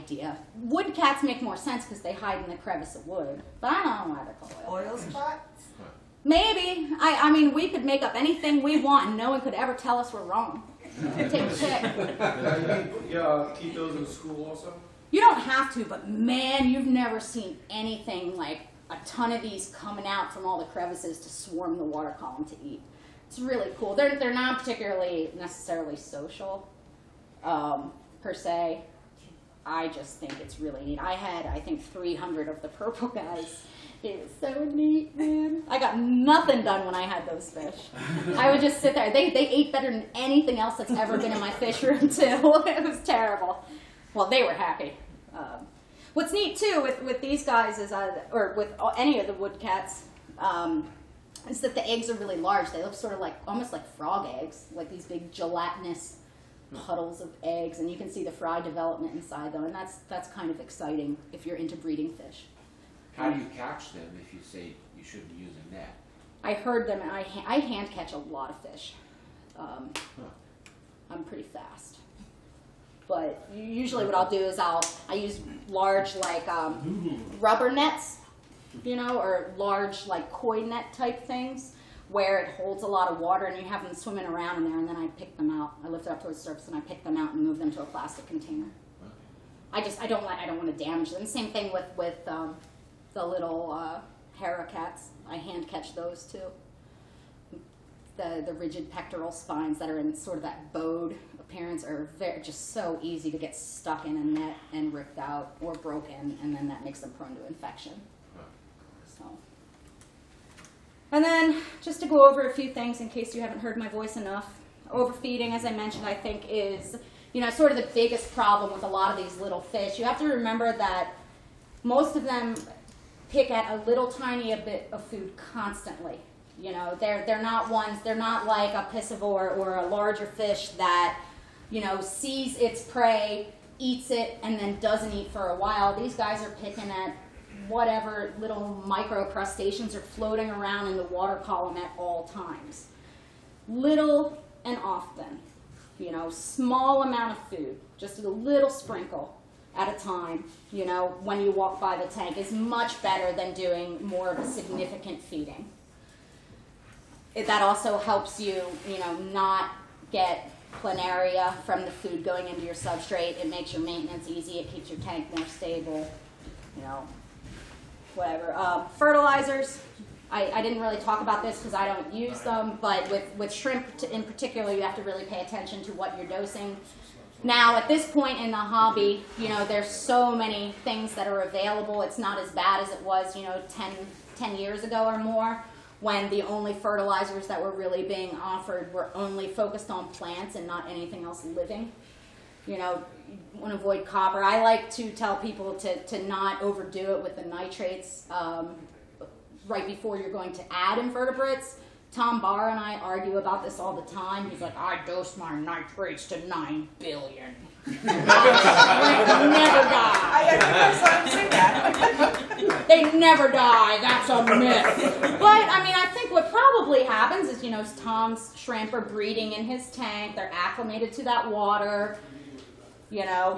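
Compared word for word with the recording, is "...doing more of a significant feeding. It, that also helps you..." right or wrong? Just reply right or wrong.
right.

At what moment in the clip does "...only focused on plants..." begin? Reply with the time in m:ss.
3:09.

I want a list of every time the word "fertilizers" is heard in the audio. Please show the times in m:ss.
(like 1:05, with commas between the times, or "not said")
2:48, 3:06.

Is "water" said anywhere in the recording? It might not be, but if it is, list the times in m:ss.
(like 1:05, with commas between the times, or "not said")
0:21, 1:23, 2:21, 3:41.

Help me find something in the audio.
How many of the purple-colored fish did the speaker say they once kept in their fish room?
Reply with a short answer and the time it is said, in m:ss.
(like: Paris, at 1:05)
300, at 0:31.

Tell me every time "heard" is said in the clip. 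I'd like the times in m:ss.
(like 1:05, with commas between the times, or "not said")
1:06, 1:53.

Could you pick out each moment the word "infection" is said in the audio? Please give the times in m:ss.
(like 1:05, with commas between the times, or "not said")
1:47.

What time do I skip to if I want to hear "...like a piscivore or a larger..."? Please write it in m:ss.
2:08.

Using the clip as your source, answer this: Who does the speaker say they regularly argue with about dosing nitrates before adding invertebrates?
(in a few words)
Tom Barr.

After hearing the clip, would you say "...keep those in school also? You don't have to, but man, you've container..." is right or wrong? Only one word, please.
wrong.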